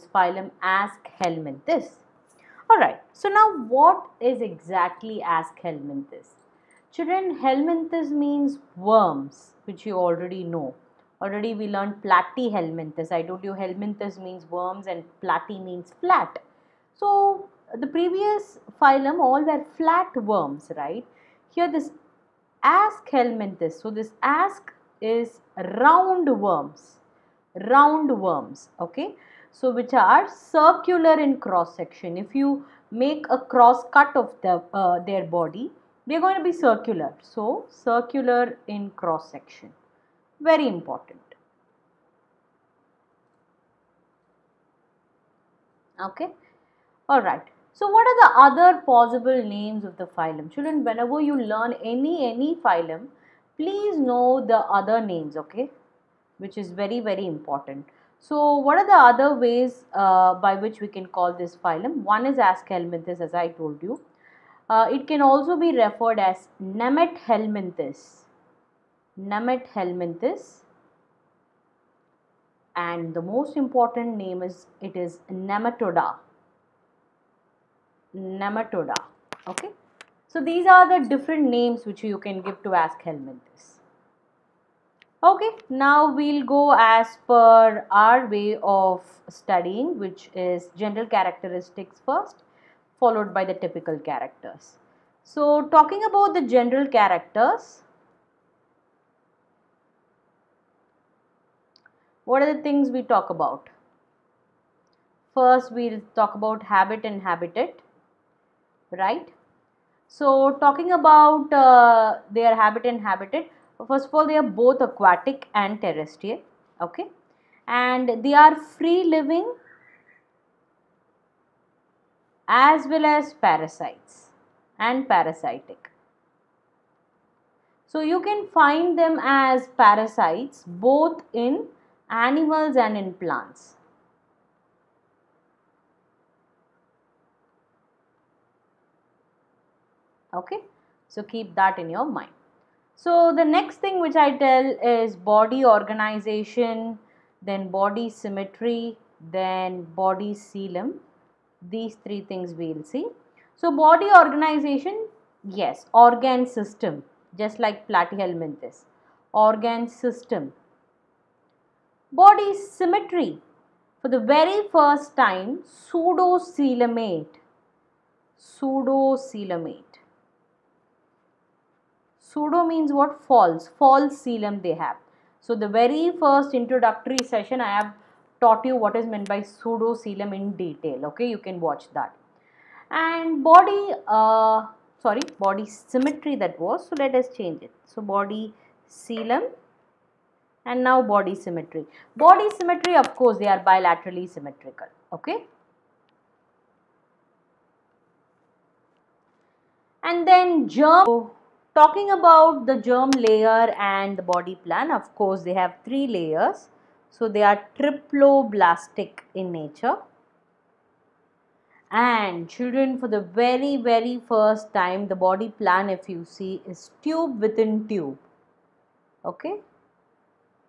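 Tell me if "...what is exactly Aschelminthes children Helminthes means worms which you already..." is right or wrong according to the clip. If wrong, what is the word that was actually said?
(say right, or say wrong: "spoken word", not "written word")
right.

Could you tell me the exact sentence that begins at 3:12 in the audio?
Body symmetry of course they are bilaterally symmetrical.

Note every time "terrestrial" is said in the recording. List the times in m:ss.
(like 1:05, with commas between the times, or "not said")
1:55.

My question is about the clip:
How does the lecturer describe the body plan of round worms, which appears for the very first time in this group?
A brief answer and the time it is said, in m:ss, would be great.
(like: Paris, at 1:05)
Tube within tube, at 3:37.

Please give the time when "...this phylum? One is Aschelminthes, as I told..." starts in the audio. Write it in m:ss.
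1:01.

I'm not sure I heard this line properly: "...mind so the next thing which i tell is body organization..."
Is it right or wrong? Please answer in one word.
right.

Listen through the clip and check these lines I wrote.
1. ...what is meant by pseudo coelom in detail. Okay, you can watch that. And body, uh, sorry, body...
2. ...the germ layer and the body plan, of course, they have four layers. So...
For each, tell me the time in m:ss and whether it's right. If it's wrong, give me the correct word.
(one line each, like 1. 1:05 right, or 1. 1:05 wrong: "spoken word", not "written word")
1. 2:58 right
2. 3:22 wrong: "three", not "four".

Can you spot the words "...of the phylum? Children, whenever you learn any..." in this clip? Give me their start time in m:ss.
0:49.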